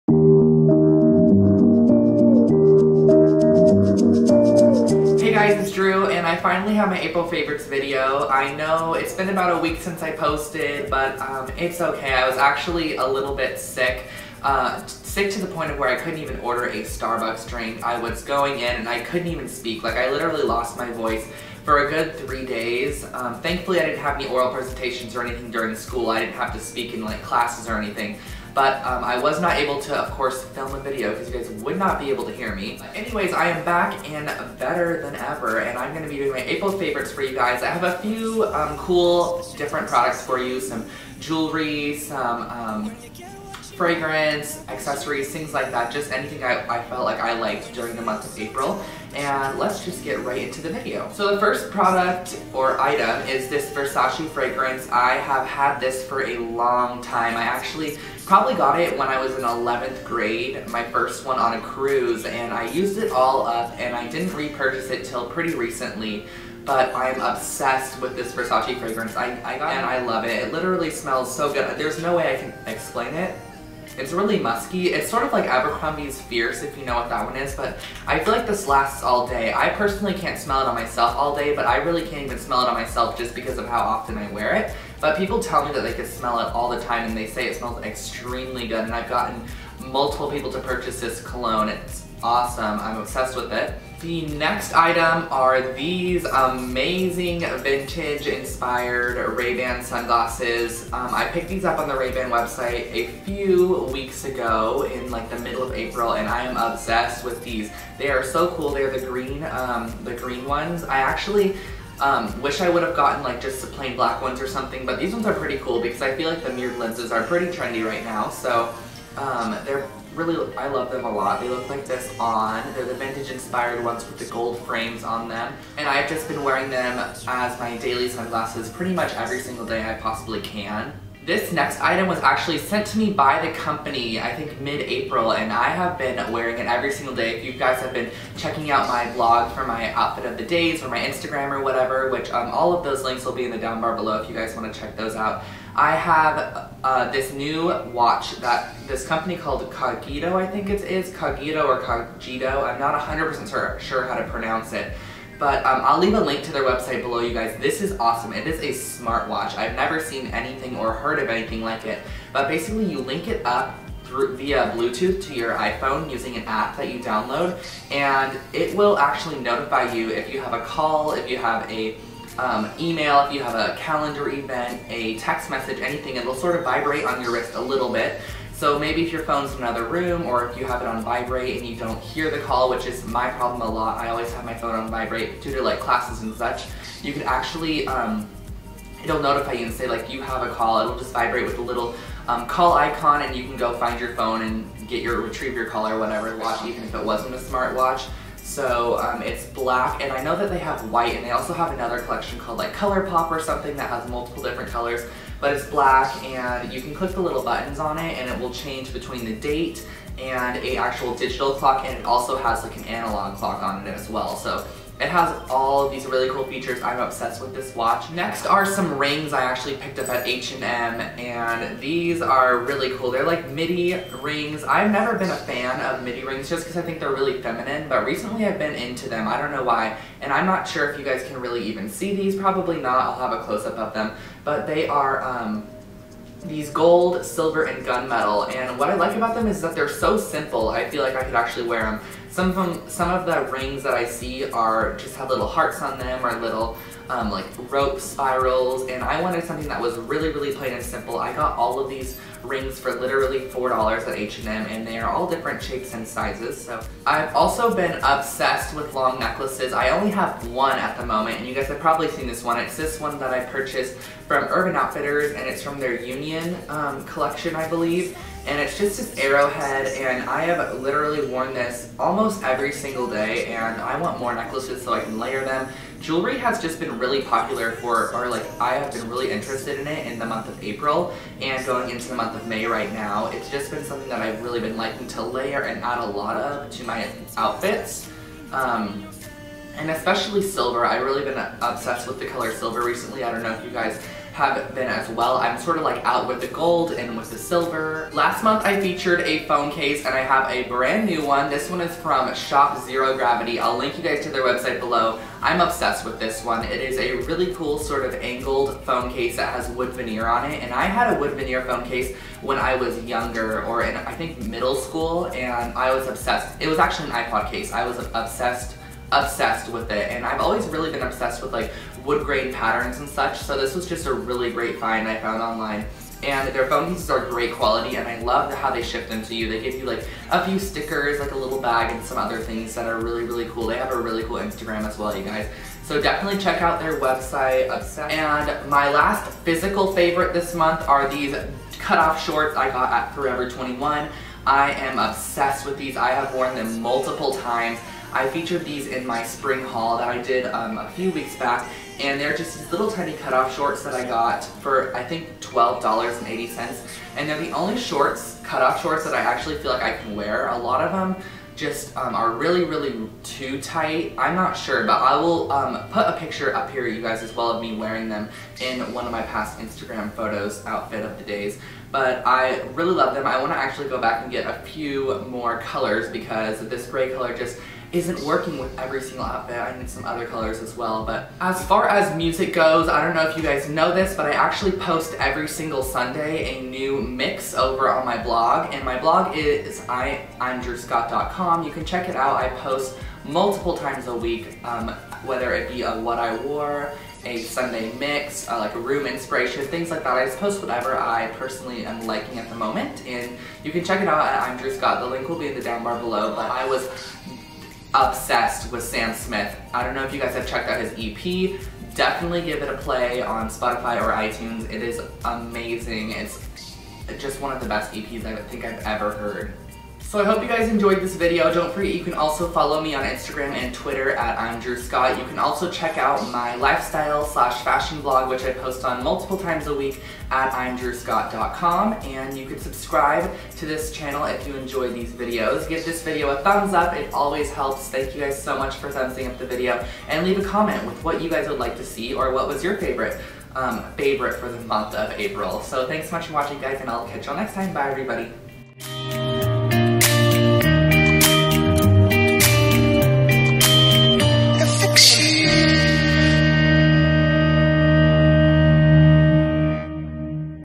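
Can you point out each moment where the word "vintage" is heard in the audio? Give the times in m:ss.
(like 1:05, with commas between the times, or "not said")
1:37, 2:02.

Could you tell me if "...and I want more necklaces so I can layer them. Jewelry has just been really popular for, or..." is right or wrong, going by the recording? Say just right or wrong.
right.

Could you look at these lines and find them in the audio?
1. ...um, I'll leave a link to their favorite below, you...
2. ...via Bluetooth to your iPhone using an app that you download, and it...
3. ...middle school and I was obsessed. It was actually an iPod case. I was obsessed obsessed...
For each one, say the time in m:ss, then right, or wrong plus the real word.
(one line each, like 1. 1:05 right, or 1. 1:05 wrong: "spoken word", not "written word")
1. 2:35 wrong: "website", not "favorite"
2. 2:44 right
3. 5:14 right.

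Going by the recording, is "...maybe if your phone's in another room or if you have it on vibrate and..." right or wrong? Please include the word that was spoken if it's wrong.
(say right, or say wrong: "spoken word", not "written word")
right.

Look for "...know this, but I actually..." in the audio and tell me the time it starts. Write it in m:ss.
6:23.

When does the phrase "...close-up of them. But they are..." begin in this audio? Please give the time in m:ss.
3:53.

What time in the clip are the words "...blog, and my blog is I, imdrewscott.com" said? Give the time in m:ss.
6:28.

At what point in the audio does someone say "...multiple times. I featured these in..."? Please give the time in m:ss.
5:46.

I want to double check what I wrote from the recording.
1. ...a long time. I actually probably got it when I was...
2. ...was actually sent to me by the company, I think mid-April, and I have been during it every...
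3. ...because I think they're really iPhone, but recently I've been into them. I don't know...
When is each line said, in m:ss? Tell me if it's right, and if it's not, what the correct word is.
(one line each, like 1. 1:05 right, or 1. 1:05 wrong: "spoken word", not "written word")
1. 0:56 right
2. 2:12 wrong: "wearing", not "during"
3. 3:46 wrong: "feminine", not "iPhone".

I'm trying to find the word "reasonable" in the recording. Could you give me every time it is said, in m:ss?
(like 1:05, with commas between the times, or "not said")
not said.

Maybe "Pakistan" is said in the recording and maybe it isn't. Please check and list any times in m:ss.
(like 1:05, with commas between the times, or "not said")
not said.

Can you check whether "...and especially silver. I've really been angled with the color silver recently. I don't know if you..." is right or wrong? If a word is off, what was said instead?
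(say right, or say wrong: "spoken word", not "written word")
wrong: "obsessed", not "angled".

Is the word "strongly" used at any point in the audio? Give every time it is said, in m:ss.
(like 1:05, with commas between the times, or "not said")
not said.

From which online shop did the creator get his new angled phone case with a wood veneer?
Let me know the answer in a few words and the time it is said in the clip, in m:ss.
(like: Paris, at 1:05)
Shop Zero Gravity, at 5:02.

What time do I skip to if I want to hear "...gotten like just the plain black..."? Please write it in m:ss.
1:52.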